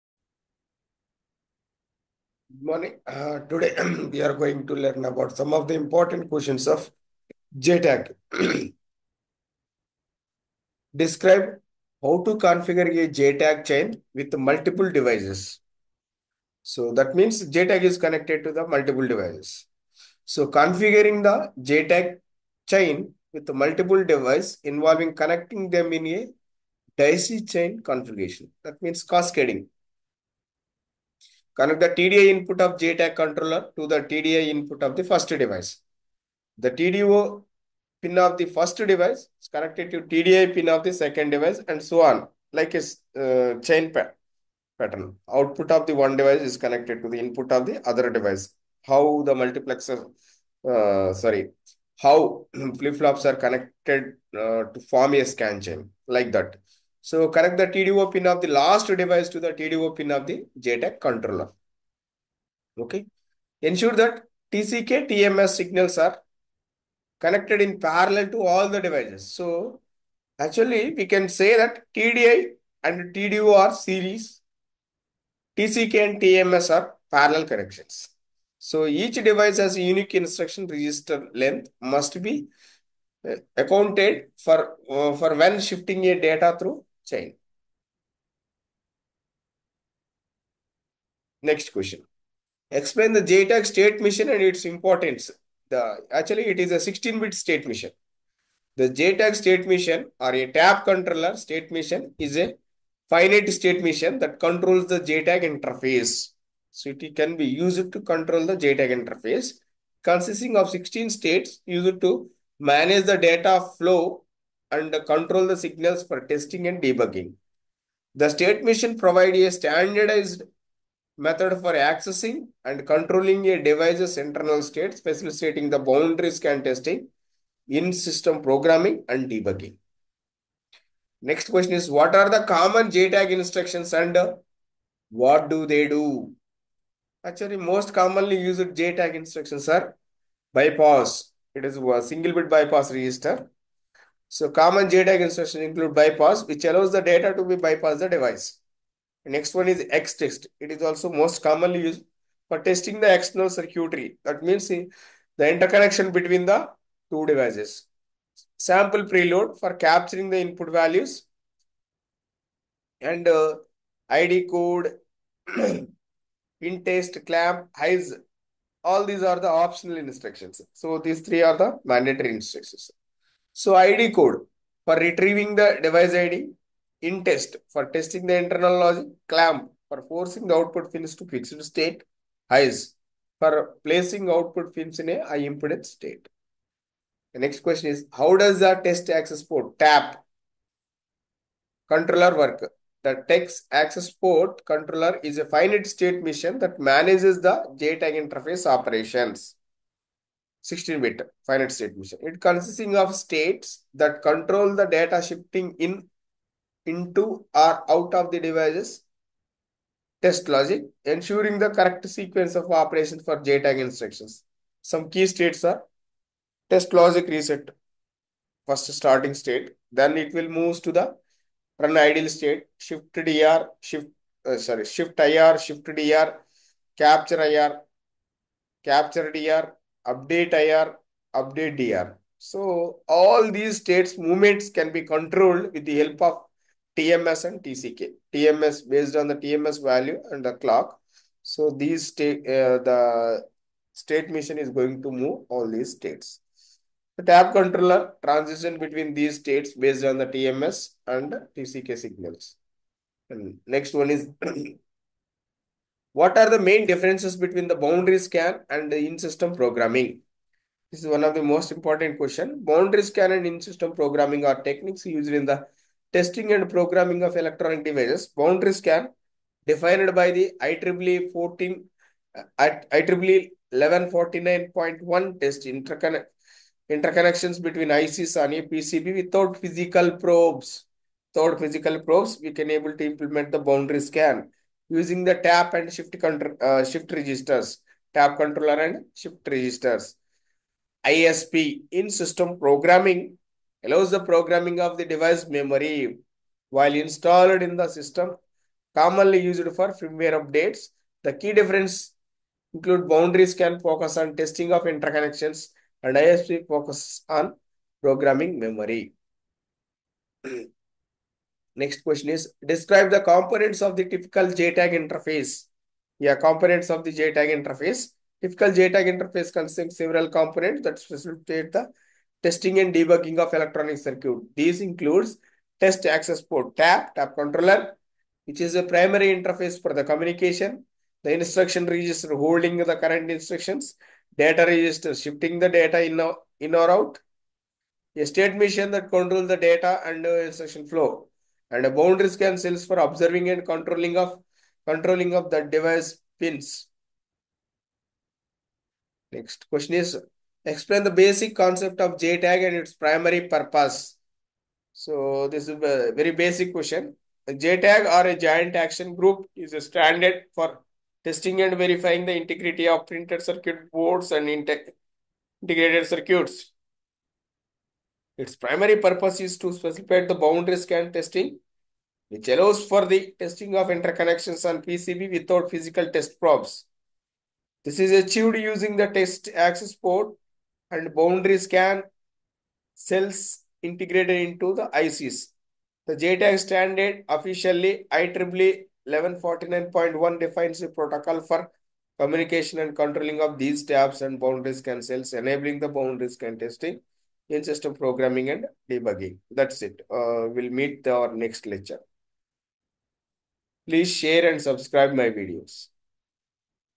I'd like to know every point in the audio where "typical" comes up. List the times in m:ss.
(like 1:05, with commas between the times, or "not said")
5:14, 5:18.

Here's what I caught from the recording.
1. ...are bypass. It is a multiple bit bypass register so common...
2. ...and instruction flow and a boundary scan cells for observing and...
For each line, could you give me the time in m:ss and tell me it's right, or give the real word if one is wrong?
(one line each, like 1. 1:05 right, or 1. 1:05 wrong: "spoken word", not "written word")
1. 2:19 wrong: "single", not "multiple"
2. 5:40 right.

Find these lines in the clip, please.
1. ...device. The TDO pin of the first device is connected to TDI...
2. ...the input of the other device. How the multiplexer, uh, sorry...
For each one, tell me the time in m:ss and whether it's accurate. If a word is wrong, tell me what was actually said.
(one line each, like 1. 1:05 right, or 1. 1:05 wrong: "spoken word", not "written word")
1. 0:35 right
2. 0:47 right.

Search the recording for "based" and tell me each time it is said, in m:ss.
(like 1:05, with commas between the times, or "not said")
3:58, 4:09.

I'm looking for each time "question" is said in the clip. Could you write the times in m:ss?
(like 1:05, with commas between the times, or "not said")
0:06, 1:31, 2:11, 3:07, 4:22, 5:12, 5:49, 5:56.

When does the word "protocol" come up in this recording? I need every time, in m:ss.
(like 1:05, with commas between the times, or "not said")
6:30.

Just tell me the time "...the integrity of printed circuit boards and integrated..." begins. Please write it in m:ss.
6:02.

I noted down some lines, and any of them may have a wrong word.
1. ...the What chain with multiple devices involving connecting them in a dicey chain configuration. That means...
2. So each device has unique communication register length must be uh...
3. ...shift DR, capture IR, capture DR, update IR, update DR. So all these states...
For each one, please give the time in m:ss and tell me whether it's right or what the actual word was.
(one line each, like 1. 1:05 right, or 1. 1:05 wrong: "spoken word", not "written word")
1. 0:21 wrong: "JTAG", not "What"
2. 1:18 wrong: "instruction", not "communication"
3. 3:45 right.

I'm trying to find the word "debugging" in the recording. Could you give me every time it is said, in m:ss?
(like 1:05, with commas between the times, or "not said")
1:56, 2:09, 5:22, 6:38.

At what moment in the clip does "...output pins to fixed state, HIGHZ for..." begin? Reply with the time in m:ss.
3:00.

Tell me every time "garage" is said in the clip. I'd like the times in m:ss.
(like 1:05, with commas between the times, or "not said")
not said.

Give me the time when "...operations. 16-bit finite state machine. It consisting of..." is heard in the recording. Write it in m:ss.
3:18.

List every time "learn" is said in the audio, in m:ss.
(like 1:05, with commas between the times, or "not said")
0:04.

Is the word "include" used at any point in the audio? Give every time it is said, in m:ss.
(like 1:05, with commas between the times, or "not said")
2:25, 5:02, 5:24.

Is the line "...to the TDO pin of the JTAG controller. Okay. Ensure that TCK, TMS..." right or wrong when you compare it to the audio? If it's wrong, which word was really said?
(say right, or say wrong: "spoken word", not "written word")
right.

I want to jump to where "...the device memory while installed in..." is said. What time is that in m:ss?
4:54.